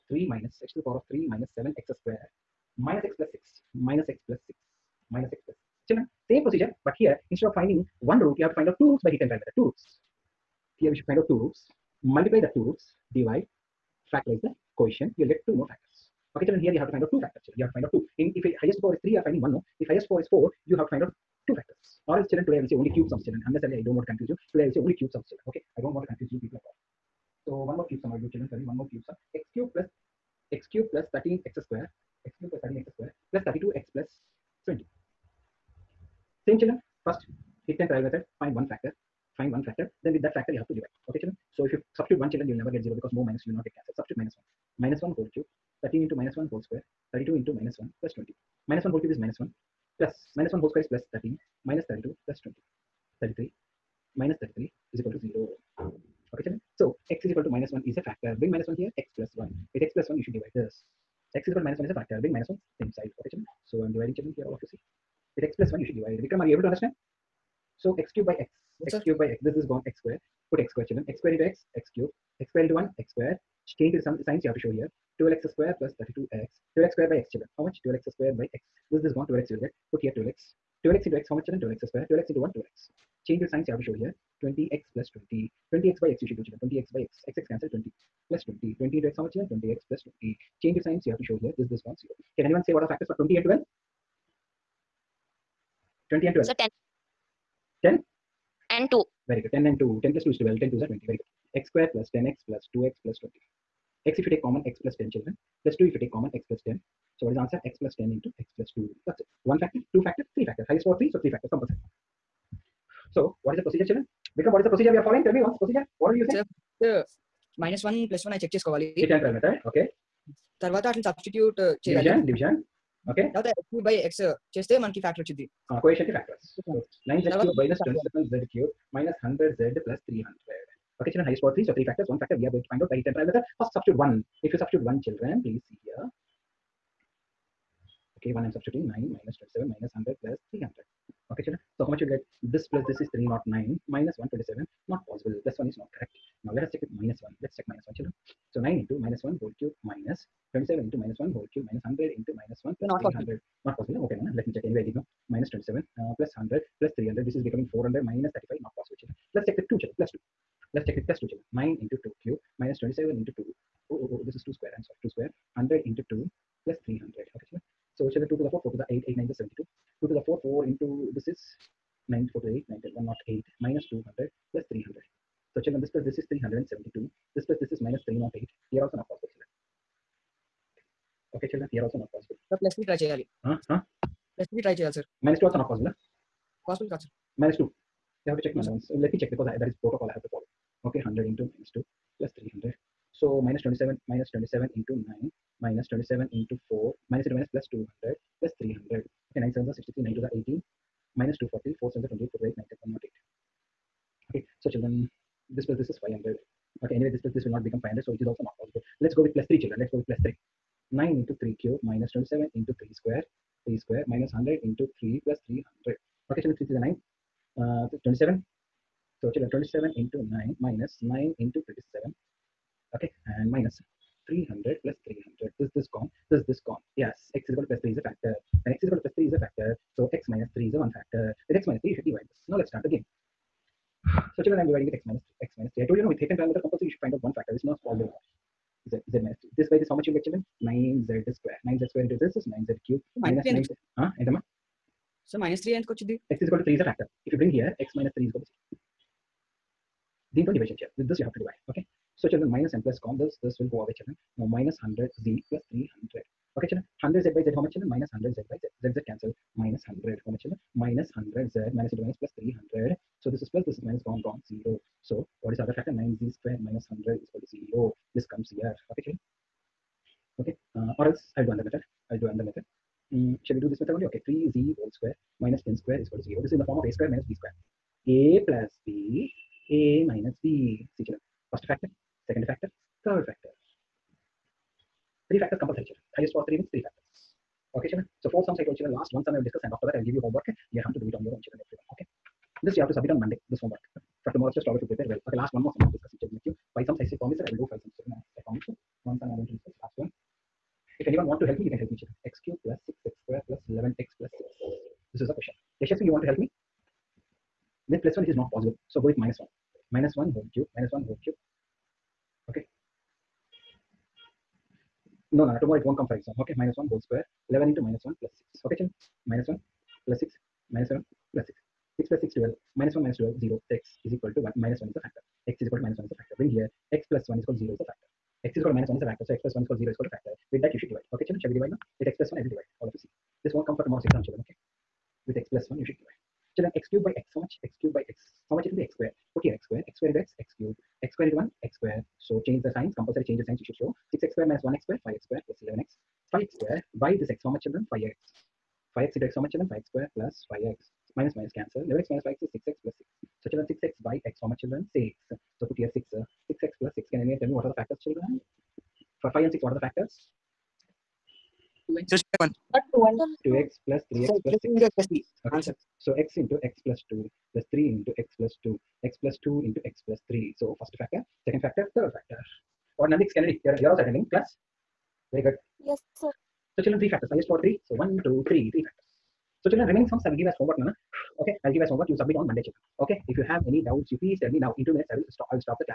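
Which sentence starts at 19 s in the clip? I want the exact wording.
If highest power is four, you have to find out two factors.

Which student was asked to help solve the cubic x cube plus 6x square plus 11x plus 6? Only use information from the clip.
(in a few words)
Yashasvi.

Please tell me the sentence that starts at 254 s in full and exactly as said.
Now minus hundred z plus three hundred.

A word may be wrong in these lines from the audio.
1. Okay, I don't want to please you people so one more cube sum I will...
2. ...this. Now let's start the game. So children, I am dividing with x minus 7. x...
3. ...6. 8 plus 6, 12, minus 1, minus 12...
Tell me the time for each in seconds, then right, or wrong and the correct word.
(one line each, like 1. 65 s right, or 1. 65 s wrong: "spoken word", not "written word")
1. 25 s wrong: "confuse", not "please"
2. 232 s wrong: "3", not "7"
3. 321 s wrong: "6", not "8".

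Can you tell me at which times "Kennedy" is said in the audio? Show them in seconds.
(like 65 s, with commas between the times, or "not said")
373 s.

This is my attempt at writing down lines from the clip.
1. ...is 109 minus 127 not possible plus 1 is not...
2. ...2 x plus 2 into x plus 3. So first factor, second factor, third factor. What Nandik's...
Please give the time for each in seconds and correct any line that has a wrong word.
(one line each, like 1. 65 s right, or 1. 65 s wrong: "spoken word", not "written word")
1. 142 s wrong: "309", not "109"
2. 368 s right.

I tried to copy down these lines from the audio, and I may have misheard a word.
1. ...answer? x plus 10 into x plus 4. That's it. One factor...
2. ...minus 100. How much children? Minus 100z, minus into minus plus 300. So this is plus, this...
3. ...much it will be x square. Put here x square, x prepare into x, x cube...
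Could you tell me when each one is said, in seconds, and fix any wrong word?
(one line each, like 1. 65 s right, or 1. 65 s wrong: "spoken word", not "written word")
1. 107 s wrong: "2", not "4"
2. 259 s right
3. 338 s wrong: "square", not "prepare".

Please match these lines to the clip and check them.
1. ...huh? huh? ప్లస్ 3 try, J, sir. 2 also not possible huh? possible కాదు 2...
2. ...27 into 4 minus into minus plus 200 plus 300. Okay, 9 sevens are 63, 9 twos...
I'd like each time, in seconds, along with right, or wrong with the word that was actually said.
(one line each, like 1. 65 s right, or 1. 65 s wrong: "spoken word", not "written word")
1. 183 s right
2. 195 s right.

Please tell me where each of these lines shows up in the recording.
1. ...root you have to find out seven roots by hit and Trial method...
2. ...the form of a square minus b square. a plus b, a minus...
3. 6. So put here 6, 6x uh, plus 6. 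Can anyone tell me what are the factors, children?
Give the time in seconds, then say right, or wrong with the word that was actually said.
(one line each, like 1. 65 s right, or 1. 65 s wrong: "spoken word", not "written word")
1. 8 s wrong: "two", not "seven"
2. 276 s right
3. 354 s right.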